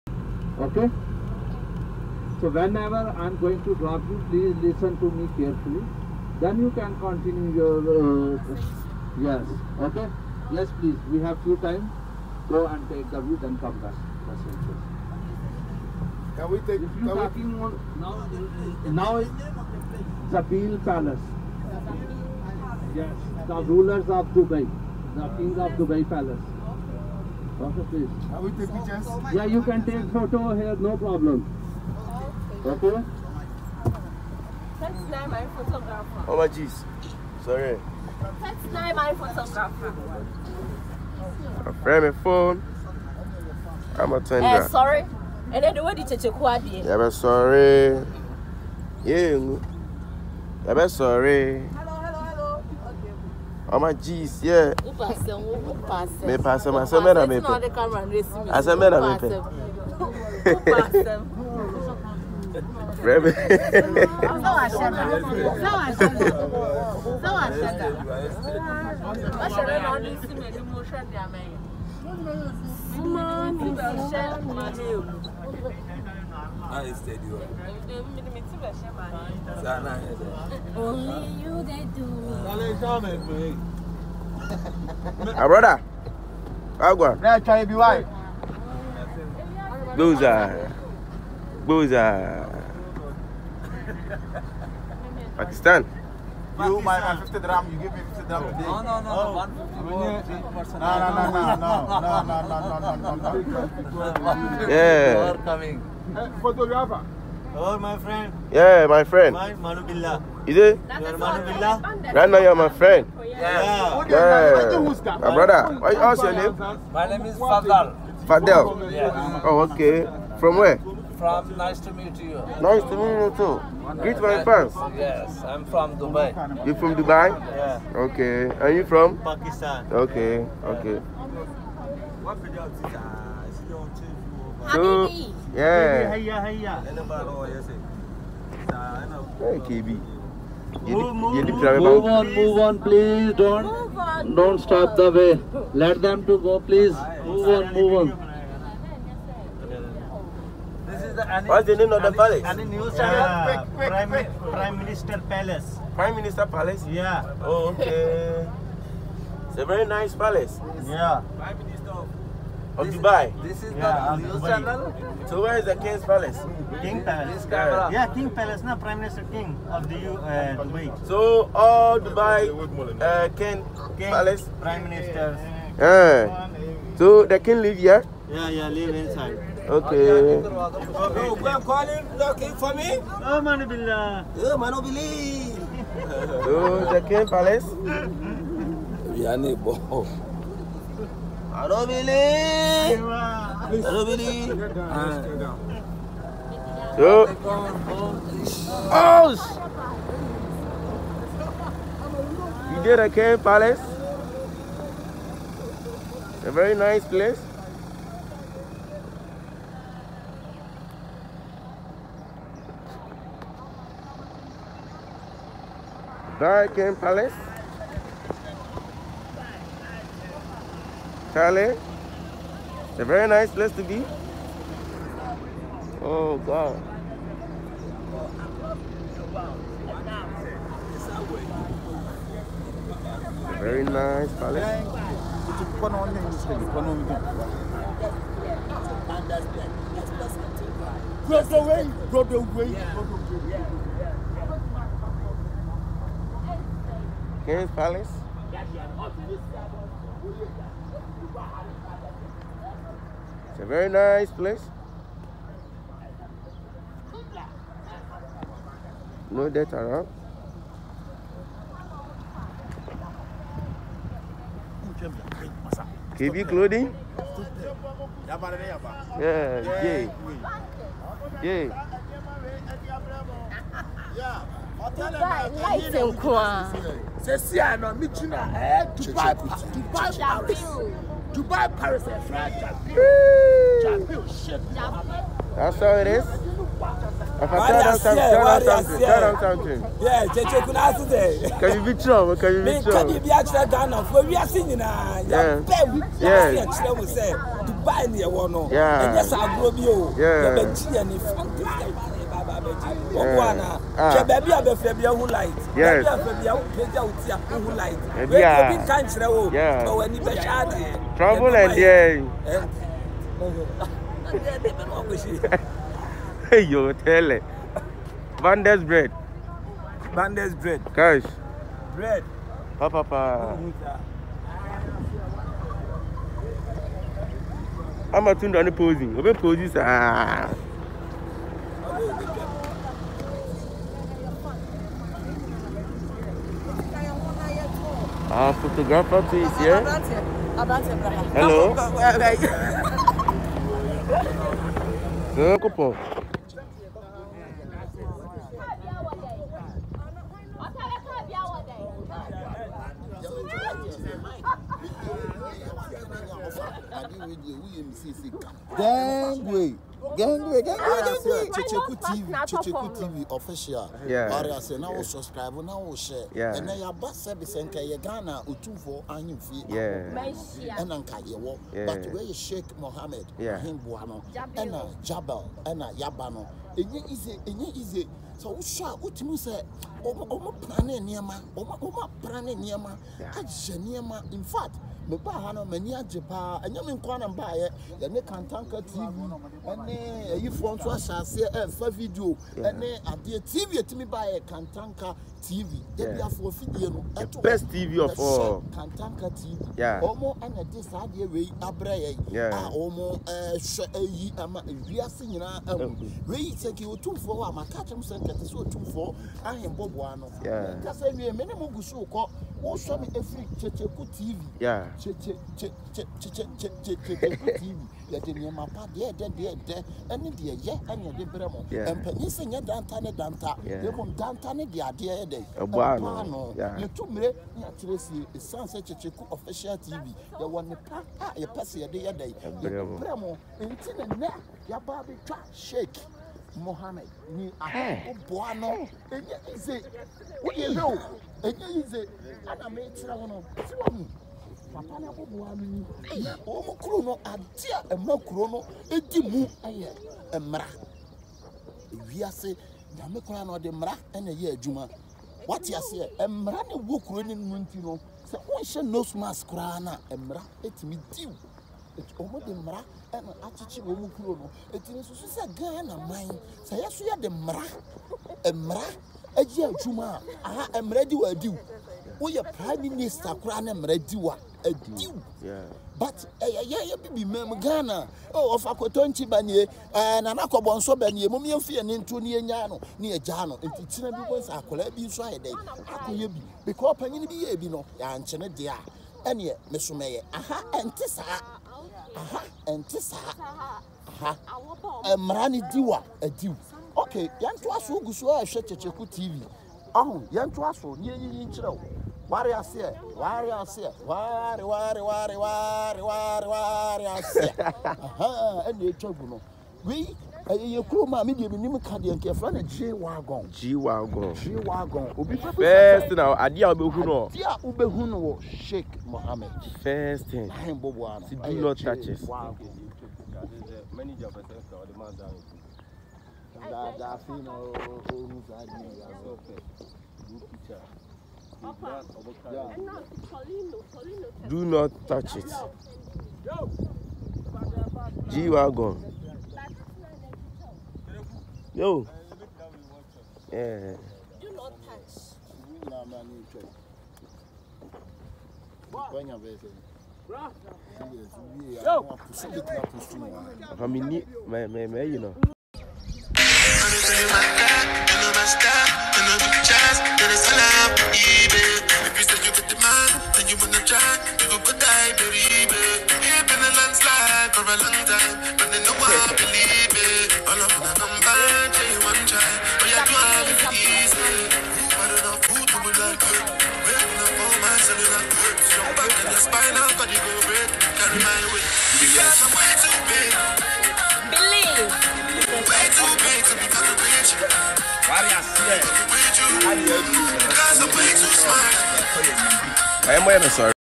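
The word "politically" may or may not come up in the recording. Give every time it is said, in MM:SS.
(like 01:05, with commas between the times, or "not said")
not said.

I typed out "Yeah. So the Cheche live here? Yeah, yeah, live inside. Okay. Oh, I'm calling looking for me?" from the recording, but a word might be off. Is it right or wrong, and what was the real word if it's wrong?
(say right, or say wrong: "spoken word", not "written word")
wrong: "King", not "Cheche".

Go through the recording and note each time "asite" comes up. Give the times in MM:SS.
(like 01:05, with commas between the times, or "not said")
04:50.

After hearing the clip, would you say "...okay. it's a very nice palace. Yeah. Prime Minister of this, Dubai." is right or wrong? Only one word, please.
right.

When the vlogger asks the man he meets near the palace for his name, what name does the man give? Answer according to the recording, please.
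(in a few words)
Fadel.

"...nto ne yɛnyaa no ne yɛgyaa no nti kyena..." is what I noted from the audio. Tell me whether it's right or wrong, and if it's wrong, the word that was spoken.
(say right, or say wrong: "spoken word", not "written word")
right.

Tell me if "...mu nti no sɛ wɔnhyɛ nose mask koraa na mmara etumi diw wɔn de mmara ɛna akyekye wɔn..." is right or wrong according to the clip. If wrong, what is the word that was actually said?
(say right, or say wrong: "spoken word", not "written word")
right.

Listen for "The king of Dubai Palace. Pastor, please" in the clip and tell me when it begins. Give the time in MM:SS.
00:25.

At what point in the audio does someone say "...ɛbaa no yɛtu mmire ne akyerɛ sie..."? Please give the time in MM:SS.
07:05.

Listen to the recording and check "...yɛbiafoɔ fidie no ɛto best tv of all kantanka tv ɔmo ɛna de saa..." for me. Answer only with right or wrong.
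right.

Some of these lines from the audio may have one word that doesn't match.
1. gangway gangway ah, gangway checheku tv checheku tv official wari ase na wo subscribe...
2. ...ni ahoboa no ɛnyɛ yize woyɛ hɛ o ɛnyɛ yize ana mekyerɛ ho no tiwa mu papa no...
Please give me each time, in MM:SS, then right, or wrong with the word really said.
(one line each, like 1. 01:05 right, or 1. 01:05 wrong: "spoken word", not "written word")
1. 06:00 right
2. 07:17 right.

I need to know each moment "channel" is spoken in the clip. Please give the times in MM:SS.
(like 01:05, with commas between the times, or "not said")
02:32, 02:44.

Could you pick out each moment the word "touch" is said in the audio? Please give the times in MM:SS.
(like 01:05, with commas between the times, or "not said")
08:55, 09:04.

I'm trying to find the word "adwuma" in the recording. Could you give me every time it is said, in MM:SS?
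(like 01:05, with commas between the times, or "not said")
07:34, 07:49.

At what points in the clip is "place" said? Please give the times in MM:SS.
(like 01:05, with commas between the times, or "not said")
03:27, 03:43, 04:14.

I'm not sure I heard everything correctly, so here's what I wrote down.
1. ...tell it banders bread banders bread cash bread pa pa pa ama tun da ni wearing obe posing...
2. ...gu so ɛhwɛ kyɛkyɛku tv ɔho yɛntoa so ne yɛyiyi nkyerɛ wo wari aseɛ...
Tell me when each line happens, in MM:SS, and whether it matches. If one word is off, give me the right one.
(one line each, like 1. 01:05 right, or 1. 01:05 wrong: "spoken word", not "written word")
1. 05:16 wrong: "posing", not "wearing"
2. 08:17 right.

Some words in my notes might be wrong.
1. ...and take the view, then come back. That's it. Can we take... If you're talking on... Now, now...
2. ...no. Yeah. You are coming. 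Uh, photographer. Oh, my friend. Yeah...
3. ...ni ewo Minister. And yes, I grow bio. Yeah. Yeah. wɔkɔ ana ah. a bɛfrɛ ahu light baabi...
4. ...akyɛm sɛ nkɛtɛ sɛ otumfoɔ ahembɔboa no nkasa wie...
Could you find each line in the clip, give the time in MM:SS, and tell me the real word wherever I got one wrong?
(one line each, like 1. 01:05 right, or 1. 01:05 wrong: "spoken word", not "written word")
1. 00:12 right
2. 01:43 right
3. 04:58 wrong: "Yeah", not "Minister"
4. 06:47 right.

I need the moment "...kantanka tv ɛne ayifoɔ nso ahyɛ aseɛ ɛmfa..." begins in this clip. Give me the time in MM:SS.
06:28.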